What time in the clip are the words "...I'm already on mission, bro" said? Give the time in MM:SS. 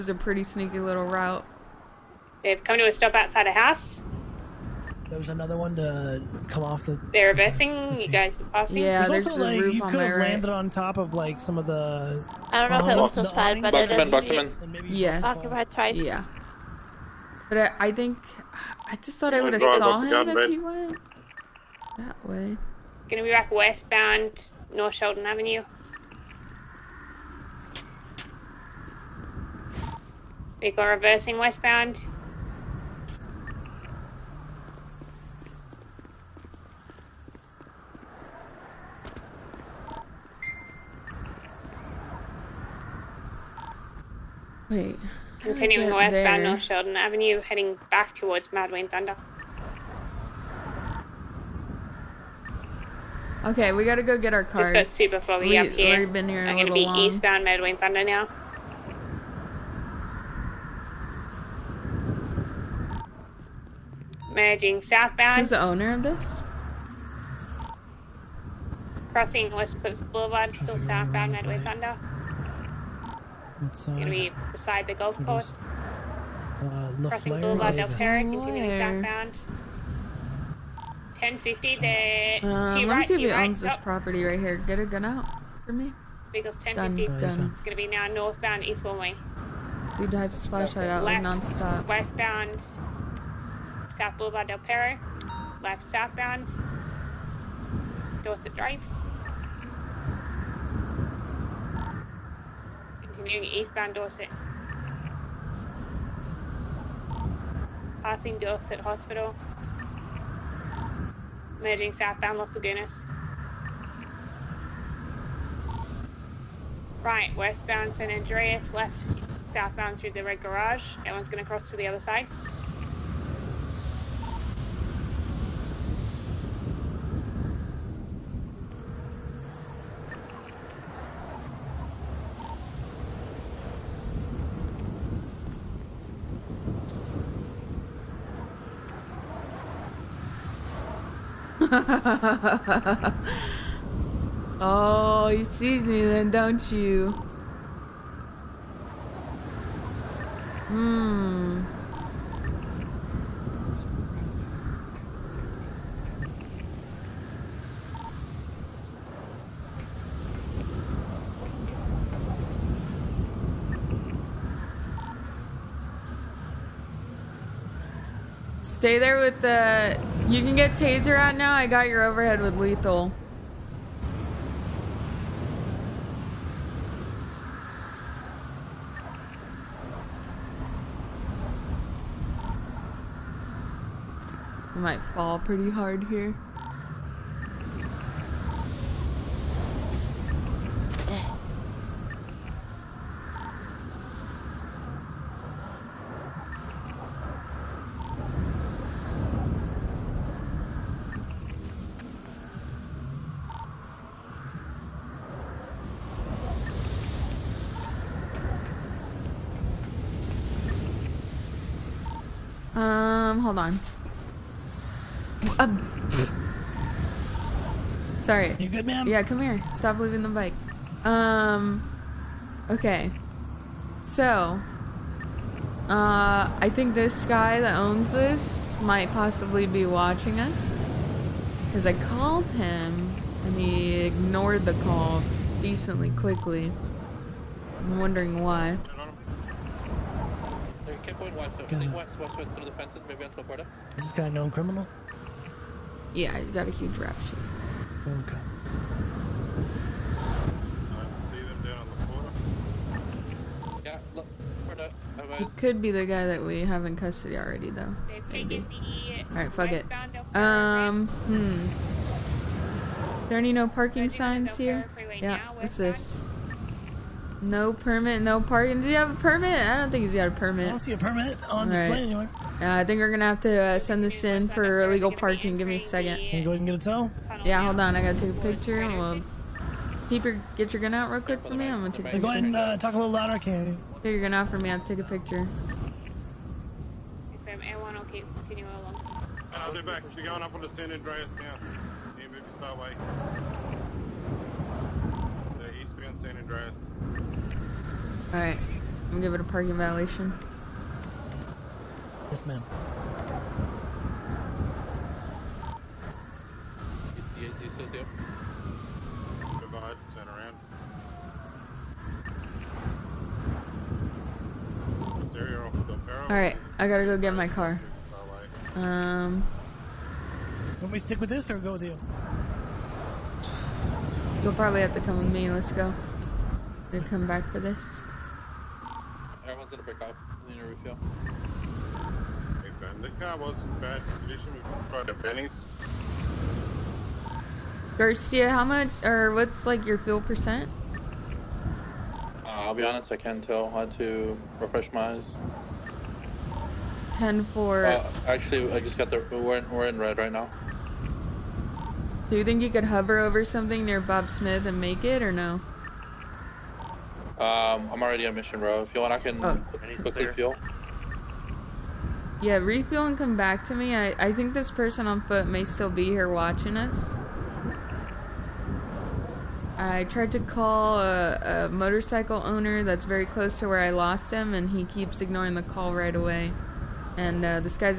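05:57.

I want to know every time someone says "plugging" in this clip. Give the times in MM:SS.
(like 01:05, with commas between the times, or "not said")
not said.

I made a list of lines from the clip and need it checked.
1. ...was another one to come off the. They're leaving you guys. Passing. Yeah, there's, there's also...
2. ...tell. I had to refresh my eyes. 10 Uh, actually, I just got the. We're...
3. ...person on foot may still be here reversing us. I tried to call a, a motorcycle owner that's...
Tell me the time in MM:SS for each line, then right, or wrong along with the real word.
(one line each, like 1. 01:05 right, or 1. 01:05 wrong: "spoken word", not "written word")
1. 00:05 wrong: "missing", not "leaving"
2. 05:43 right
3. 06:04 wrong: "watching", not "reversing".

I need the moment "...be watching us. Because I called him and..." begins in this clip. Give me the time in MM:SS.
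03:49.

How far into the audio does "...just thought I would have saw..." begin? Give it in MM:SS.
00:18.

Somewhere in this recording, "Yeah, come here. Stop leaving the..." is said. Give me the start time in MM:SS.
03:39.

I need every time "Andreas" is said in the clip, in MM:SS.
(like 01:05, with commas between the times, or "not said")
01:58, 04:50, 04:56.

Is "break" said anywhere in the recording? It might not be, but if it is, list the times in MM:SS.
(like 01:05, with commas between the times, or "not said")
05:29.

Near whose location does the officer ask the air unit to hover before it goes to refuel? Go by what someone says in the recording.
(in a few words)
Bob Smith.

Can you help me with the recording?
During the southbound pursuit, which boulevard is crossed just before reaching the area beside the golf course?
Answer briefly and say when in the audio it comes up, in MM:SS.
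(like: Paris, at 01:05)
West Eclipse Boulevard, at 01:09.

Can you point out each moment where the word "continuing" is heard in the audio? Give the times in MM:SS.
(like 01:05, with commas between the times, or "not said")
00:45, 01:18.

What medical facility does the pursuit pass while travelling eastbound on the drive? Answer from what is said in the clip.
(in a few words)
Dorset Hospital.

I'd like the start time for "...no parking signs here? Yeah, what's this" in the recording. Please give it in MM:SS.
04:23.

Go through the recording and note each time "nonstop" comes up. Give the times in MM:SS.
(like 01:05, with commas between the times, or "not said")
01:31.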